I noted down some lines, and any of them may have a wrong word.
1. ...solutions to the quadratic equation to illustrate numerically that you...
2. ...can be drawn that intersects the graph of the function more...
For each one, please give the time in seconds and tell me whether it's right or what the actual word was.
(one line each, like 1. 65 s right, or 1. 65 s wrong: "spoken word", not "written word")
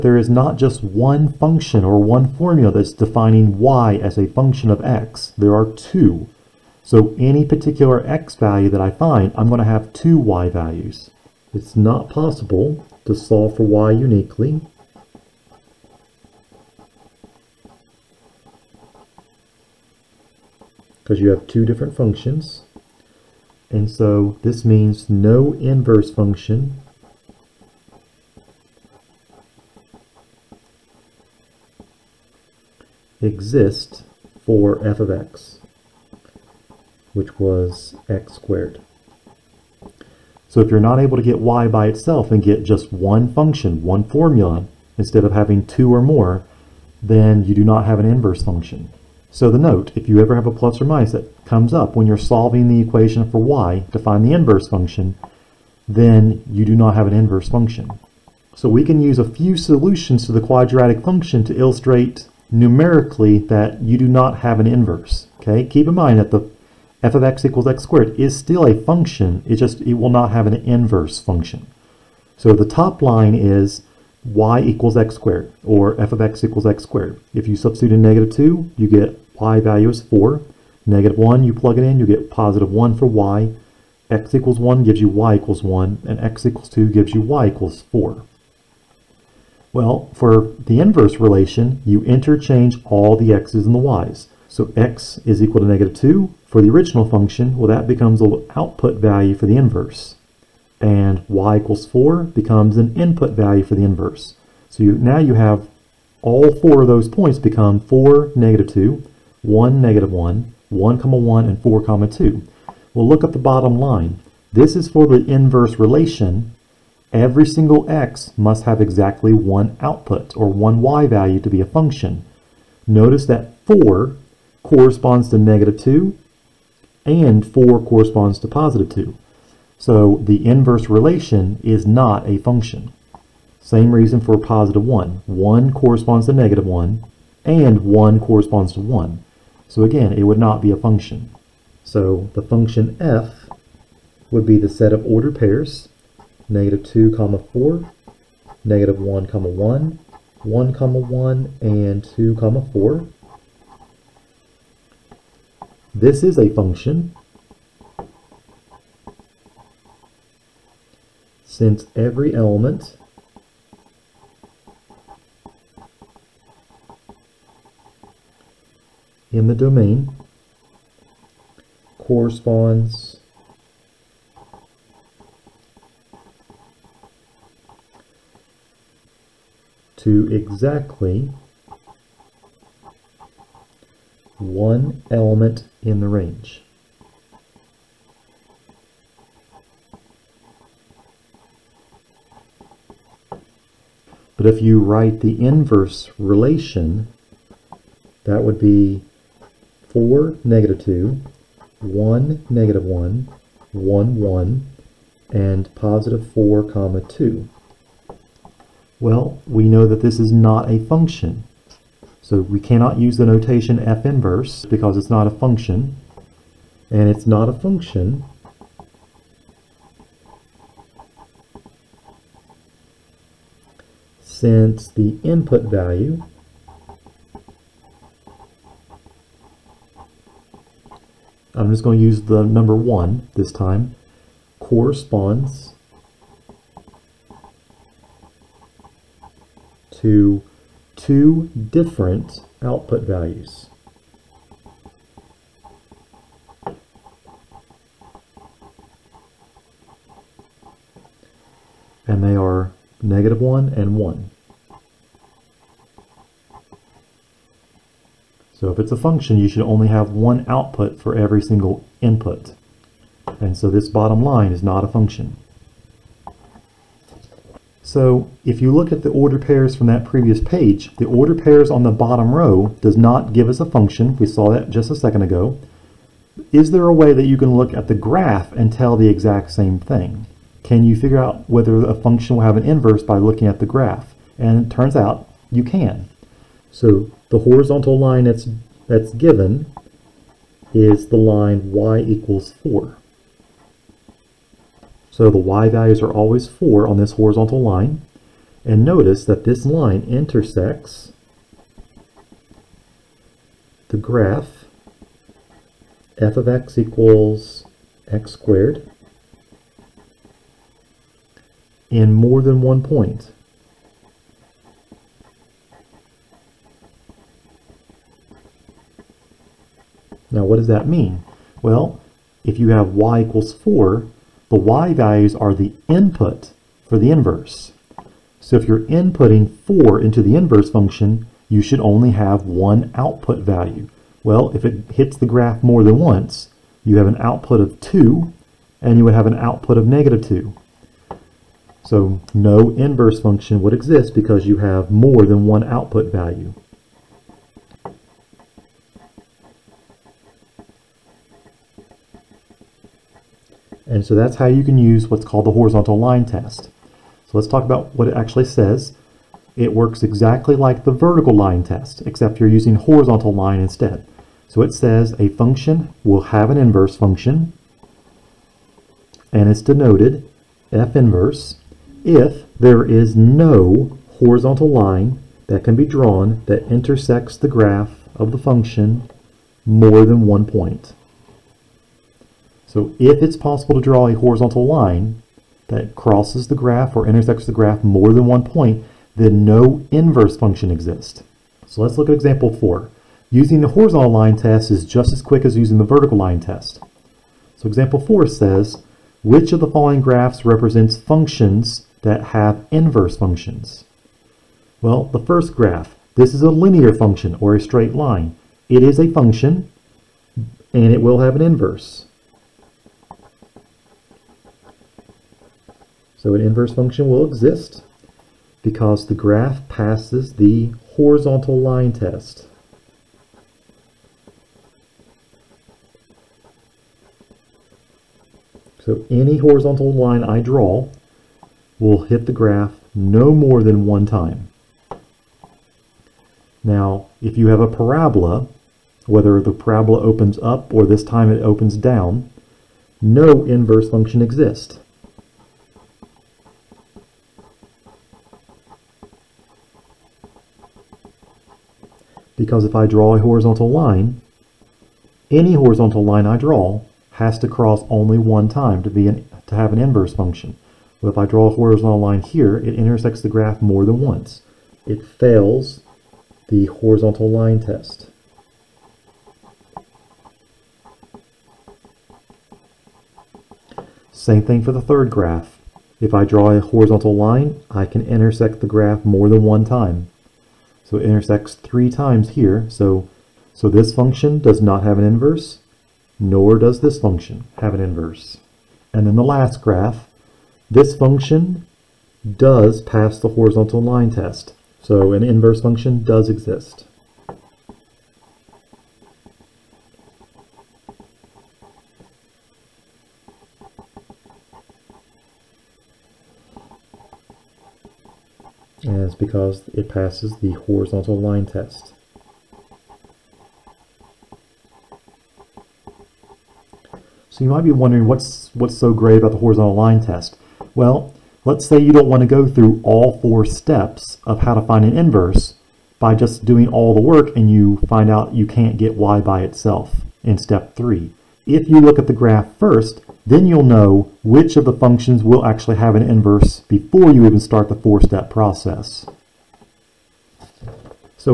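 1. 59 s wrong: "function", not "equation"
2. 375 s right.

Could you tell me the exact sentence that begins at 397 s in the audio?
So example four says, which of the following graphs represents functions that have inverse functions?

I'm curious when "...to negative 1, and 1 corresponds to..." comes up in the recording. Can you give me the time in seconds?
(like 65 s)
136 s.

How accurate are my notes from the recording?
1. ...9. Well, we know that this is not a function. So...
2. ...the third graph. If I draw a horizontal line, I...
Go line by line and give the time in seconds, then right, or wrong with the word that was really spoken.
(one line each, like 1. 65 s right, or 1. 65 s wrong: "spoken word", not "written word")
1. 207 s wrong: "2", not "9"
2. 474 s right.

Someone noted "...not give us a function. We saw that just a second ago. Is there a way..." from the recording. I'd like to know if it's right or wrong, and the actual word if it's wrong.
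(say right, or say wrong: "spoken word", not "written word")
right.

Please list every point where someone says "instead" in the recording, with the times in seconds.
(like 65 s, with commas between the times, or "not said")
44 s, 363 s.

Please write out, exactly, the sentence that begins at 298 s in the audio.
And notice that this line intersects the graph f of x equals x squared in more than one point.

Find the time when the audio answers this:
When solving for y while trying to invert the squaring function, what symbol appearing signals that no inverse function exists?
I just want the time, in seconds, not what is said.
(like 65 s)
50 s.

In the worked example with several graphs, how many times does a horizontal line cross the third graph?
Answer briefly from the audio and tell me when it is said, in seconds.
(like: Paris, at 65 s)
3, at 481 s.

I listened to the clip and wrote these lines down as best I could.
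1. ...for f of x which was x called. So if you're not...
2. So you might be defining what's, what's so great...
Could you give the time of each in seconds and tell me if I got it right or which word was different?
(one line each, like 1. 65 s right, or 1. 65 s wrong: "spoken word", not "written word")
1. 34 s wrong: "squared", not "called"
2. 517 s wrong: "wondering", not "defining".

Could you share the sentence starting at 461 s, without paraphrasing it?
But if I draw a horizontal line here, it intersects the graph more than once.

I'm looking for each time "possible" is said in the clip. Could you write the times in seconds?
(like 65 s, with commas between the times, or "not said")
12 s, 383 s.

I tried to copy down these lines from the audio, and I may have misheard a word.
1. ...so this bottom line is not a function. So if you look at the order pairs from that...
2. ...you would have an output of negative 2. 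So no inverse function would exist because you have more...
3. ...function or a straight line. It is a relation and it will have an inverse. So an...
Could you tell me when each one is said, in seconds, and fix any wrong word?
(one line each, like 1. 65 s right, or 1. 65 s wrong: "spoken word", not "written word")
1. 263 s right
2. 338 s right
3. 406 s wrong: "function", not "relation".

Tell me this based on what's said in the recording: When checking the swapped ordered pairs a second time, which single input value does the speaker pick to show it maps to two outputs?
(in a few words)
1.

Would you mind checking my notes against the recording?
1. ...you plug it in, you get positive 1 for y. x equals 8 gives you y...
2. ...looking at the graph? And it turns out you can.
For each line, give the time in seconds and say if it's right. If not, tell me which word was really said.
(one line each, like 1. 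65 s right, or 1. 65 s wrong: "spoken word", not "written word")
1. 81 s wrong: "1", not "8"
2. 283 s right.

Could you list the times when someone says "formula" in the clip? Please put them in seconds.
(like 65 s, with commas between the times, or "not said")
2 s, 44 s.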